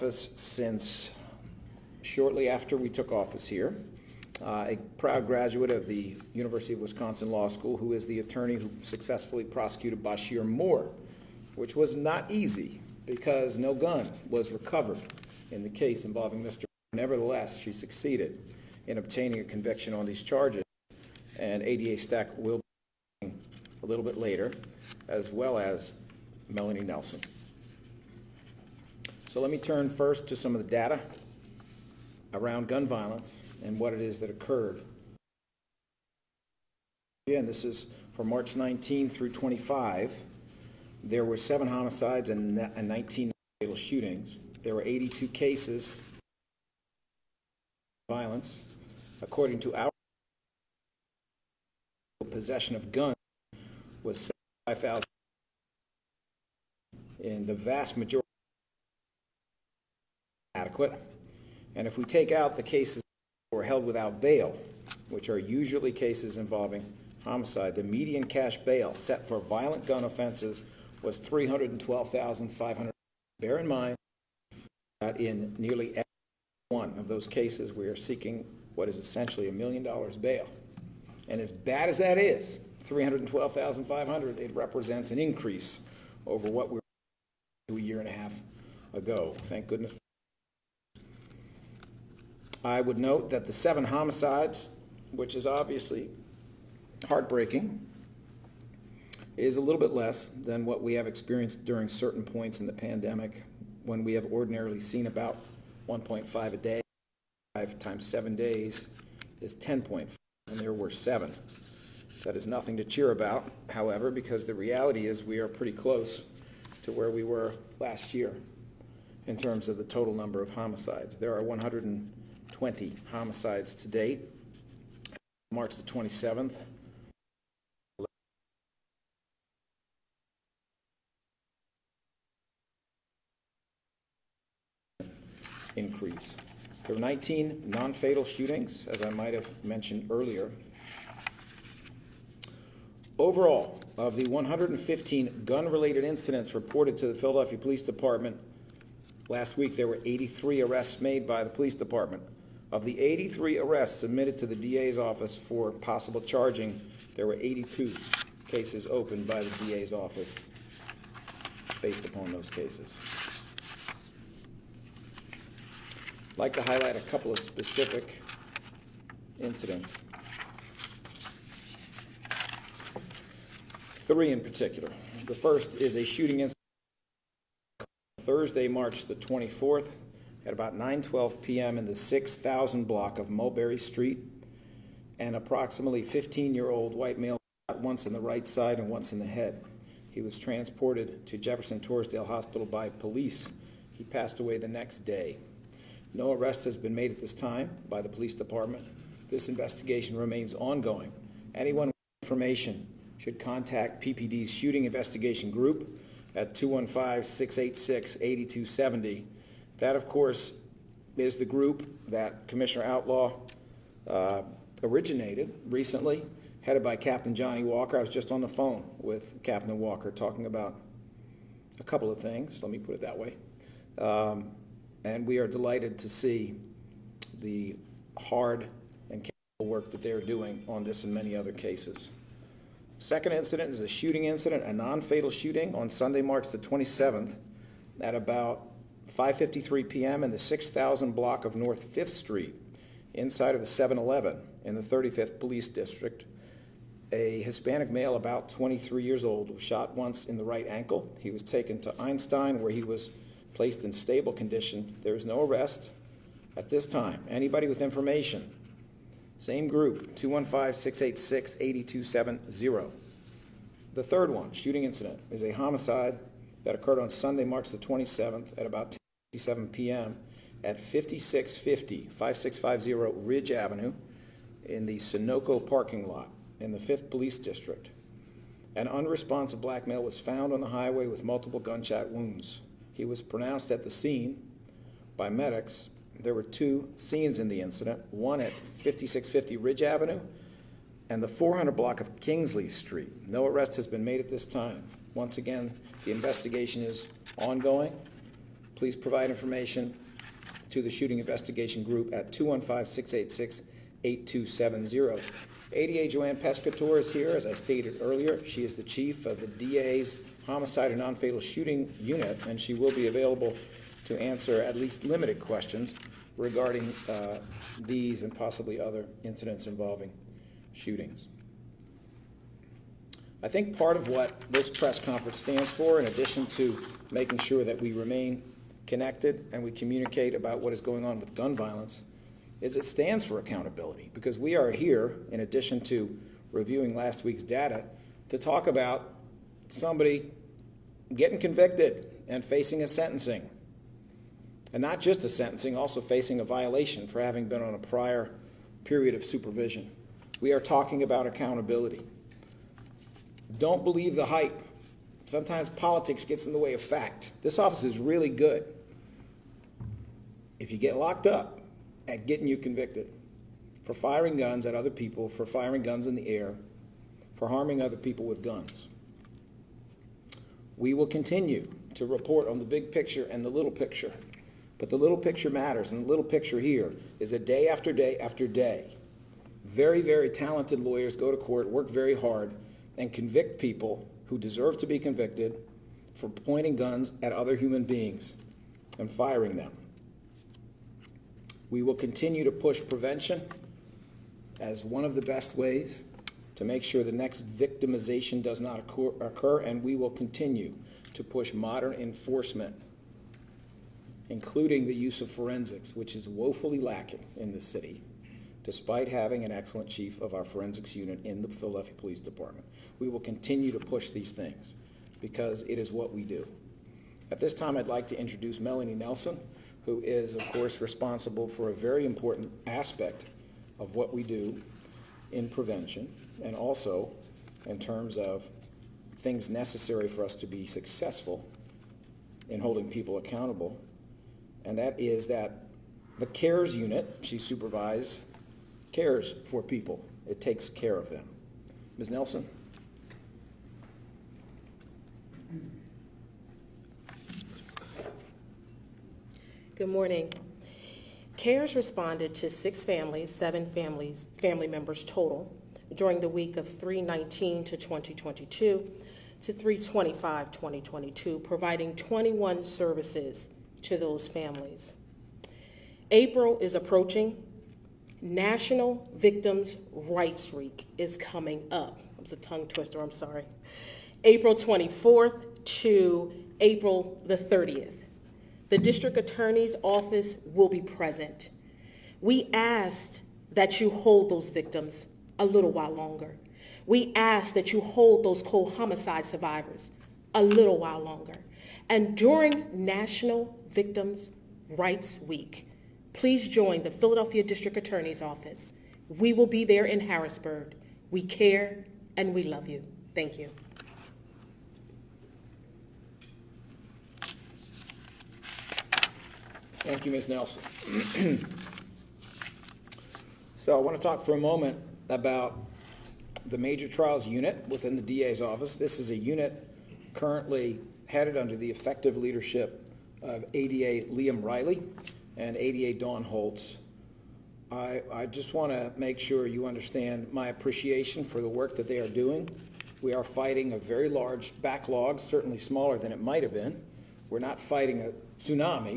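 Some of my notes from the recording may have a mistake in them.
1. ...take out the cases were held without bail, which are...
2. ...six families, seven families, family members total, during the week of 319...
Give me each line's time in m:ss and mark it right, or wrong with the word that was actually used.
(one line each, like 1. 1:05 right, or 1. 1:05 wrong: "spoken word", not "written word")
1. 1:02 right
2. 7:32 right.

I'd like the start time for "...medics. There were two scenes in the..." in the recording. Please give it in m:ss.
4:45.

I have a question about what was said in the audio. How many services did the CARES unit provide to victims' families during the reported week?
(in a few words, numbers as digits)
21.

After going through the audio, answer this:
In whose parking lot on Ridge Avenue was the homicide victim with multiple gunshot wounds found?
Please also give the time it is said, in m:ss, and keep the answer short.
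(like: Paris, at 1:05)
Sunoco, at 4:34.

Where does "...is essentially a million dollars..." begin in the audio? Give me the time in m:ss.
1:18.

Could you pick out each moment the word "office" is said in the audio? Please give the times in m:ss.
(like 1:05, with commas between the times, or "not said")
0:03, 2:34, 2:39, 5:57, 7:59, 8:18, 8:38.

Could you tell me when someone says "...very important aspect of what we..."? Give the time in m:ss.
7:01.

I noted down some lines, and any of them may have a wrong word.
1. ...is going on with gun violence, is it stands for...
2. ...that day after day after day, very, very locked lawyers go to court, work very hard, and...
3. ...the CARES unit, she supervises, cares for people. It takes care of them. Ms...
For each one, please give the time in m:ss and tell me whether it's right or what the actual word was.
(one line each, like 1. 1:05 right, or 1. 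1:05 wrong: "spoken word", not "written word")
1. 5:30 right
2. 6:17 wrong: "talented", not "locked"
3. 7:16 right.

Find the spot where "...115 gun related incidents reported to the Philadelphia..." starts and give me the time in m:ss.
2:24.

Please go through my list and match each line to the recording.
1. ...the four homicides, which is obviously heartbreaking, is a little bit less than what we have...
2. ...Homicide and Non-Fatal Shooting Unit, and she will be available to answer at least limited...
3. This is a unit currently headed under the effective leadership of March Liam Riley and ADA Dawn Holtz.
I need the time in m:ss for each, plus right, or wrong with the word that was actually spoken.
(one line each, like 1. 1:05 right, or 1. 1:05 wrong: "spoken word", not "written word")
1. 1:33 wrong: "seven", not "four"
2. 5:10 right
3. 8:38 wrong: "ADA", not "March".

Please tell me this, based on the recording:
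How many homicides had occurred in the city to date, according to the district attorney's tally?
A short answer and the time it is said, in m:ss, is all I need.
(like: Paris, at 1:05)
120, at 2:01.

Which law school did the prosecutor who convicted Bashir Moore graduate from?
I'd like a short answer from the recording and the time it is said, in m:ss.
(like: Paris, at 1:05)
University of Wisconsin Law School, at 0:06.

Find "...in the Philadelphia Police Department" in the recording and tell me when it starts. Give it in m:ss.
6:51.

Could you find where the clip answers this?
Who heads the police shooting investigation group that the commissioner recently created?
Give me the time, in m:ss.
3:36.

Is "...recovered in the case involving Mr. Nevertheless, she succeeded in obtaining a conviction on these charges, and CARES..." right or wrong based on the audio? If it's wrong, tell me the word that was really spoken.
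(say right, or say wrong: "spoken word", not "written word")
wrong: "ADA", not "CARES".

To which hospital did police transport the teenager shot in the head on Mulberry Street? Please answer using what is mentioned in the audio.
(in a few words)
Jefferson Torresdale Hospital.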